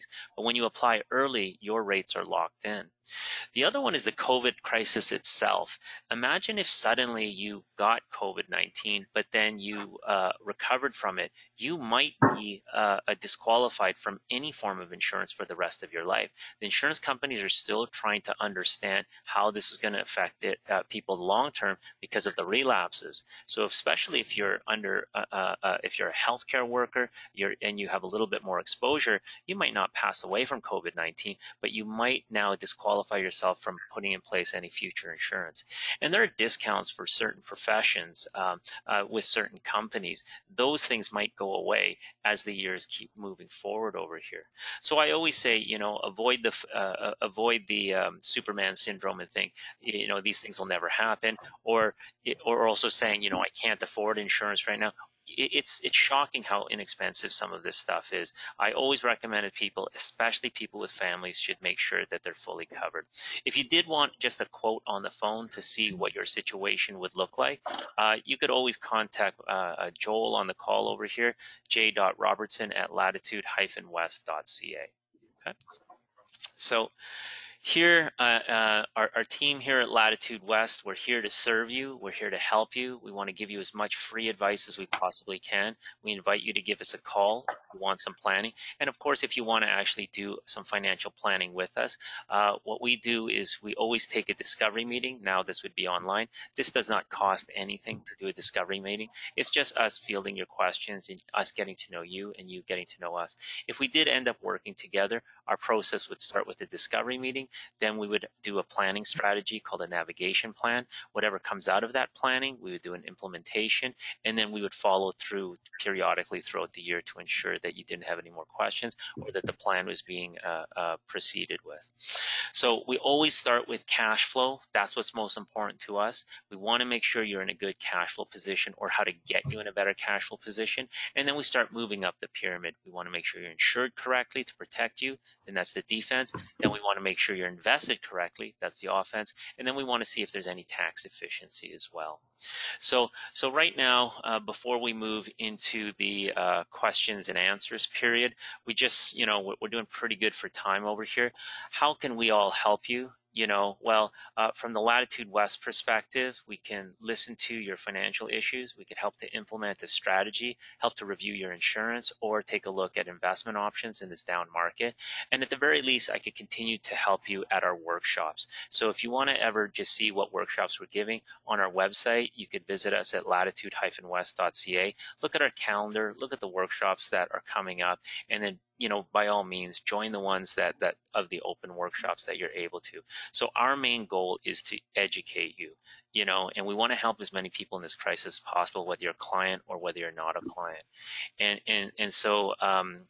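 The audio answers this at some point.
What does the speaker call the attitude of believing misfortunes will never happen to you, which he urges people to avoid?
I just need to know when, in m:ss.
0:48.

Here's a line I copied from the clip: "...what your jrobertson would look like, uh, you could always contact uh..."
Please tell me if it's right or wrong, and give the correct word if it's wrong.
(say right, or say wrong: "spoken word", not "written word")
wrong: "situation", not "jrobertson".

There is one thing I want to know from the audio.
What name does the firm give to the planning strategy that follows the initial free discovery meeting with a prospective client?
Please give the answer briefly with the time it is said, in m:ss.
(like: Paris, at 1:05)
navigation plan, at 1:49.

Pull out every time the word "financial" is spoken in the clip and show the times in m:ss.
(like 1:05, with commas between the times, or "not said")
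1:30, 2:37.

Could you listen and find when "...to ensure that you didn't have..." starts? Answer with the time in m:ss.
1:57.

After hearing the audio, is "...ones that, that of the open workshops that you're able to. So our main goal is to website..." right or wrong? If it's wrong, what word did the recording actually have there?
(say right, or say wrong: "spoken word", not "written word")
wrong: "educate", not "website".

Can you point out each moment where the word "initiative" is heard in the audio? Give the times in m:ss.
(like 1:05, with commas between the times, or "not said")
not said.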